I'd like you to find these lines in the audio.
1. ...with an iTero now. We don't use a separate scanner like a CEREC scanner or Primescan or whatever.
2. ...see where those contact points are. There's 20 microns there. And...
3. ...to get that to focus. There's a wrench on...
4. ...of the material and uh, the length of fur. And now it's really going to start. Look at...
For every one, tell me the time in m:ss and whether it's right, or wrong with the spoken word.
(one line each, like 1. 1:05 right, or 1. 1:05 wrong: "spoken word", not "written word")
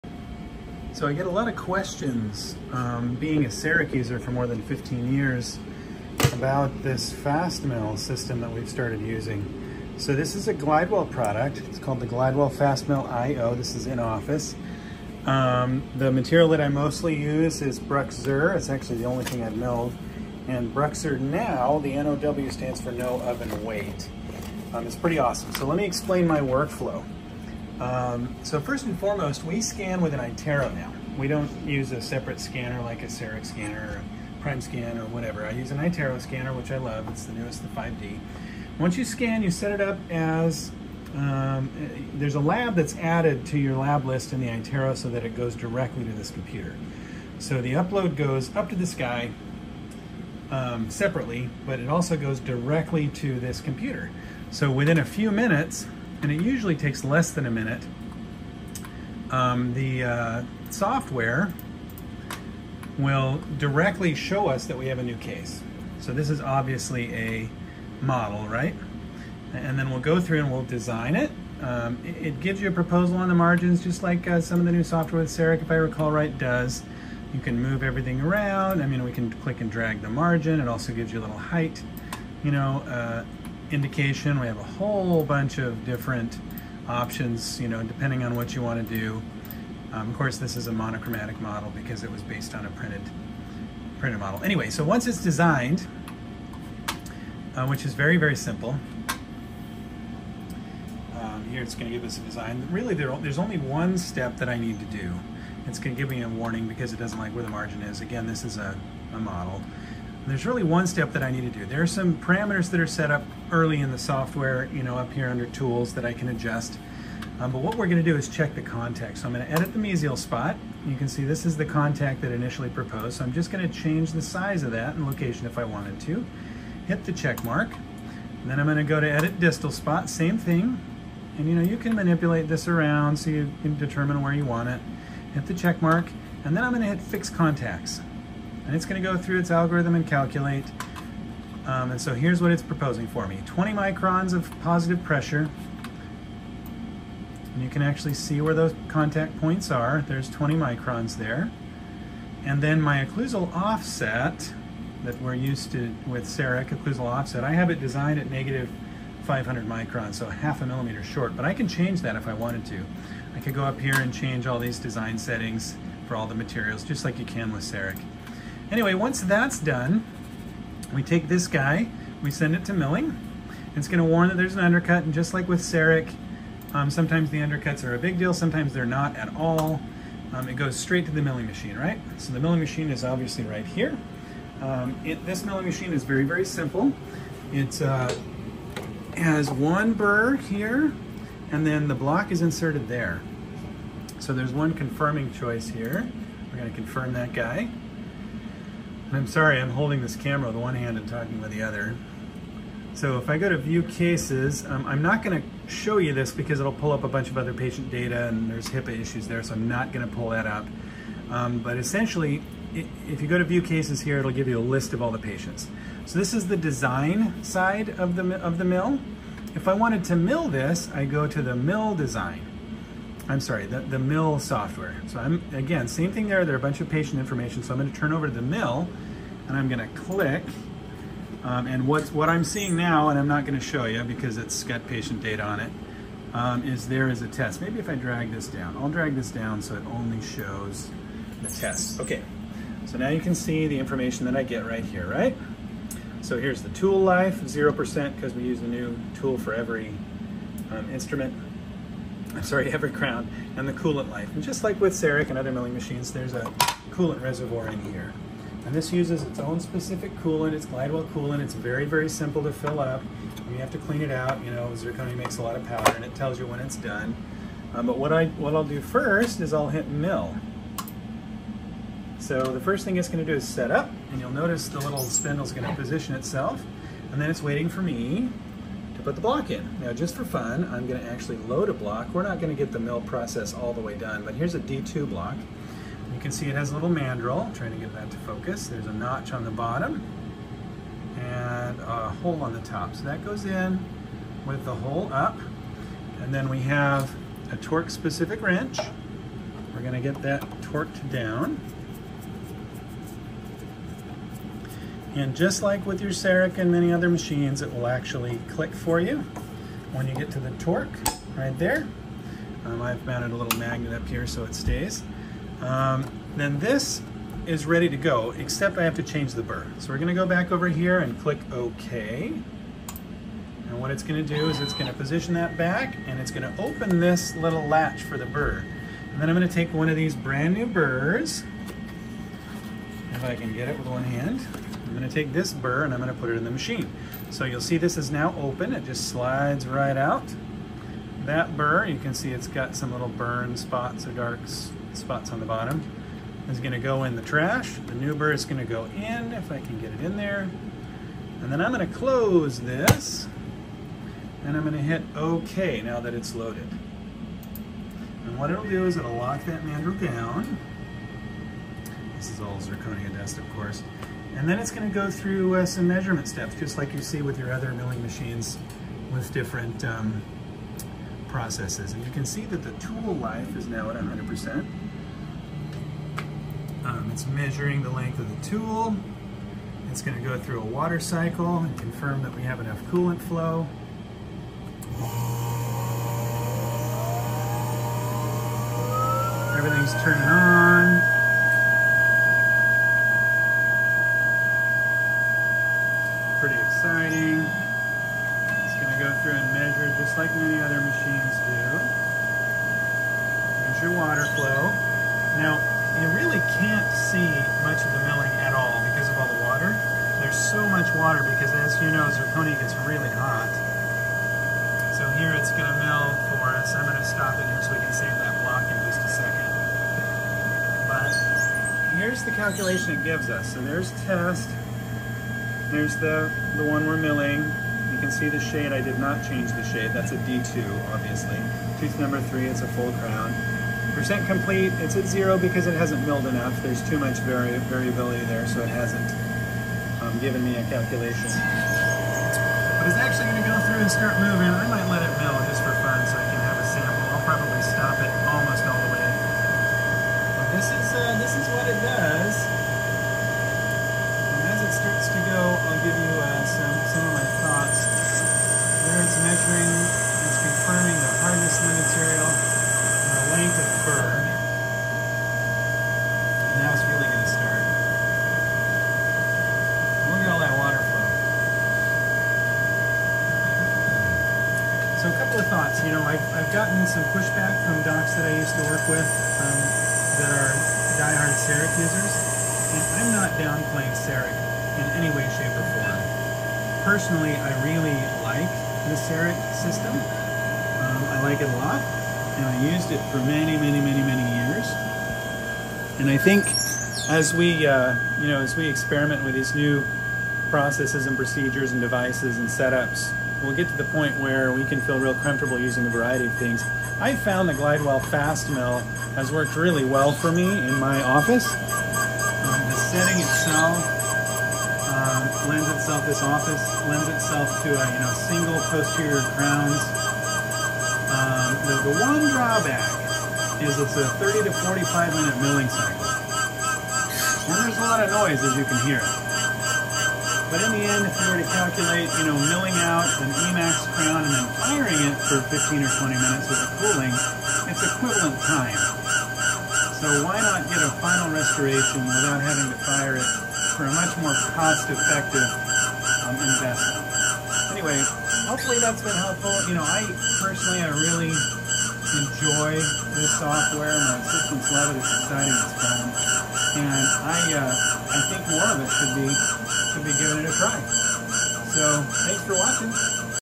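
1. 0:30 right
2. 2:28 right
3. 4:47 wrong: "notch", not "wrench"
4. 7:41 right.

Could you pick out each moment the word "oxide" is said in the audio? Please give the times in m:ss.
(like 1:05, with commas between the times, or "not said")
not said.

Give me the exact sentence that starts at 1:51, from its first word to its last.
There are some parameters that are set up early in the software, you know, up here under tools that I can adjust.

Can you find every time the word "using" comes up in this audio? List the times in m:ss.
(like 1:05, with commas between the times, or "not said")
0:08, 8:25.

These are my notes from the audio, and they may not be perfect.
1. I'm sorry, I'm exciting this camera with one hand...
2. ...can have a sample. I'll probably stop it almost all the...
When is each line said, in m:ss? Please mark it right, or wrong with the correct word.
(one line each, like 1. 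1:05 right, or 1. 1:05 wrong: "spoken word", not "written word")
1. 3:19 wrong: "holding", not "exciting"
2. 7:26 right.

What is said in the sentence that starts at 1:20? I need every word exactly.
It also gives you a little height.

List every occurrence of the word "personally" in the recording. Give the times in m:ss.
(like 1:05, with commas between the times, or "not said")
8:06, 9:10.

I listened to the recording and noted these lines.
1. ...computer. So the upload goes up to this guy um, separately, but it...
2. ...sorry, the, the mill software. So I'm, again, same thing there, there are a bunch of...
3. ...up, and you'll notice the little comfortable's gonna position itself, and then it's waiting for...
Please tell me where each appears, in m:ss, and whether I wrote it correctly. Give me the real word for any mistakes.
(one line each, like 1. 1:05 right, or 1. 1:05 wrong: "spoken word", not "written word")
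1. 0:46 right
2. 3:43 right
3. 4:33 wrong: "spindle", not "comfortable".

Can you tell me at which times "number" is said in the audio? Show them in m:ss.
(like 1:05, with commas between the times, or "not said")
7:11.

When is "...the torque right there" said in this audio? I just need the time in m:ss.
5:10.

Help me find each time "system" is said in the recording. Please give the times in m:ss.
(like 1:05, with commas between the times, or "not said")
0:07, 8:09.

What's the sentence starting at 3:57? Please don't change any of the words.
Maybe if I drag this down, I'll drag this down so it only shows the test.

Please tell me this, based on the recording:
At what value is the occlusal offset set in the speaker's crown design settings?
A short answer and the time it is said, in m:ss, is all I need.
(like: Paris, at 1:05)
-500 microns, at 2:38.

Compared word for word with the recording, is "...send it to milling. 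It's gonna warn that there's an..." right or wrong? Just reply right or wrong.
right.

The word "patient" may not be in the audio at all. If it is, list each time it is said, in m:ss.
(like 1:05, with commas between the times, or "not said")
3:27, 3:35, 3:46, 3:54.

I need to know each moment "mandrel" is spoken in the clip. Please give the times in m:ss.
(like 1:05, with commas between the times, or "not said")
4:46, 5:59.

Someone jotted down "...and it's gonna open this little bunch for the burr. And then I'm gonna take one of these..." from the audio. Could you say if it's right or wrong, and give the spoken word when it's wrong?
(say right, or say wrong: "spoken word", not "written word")
wrong: "latch", not "bunch".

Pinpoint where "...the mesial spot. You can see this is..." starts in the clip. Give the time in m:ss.
1:59.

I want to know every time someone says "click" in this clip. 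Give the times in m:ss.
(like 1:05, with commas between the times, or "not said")
1:19, 3:49, 5:08, 5:21.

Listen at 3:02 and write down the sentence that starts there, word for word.
So the milling machine is obviously right here.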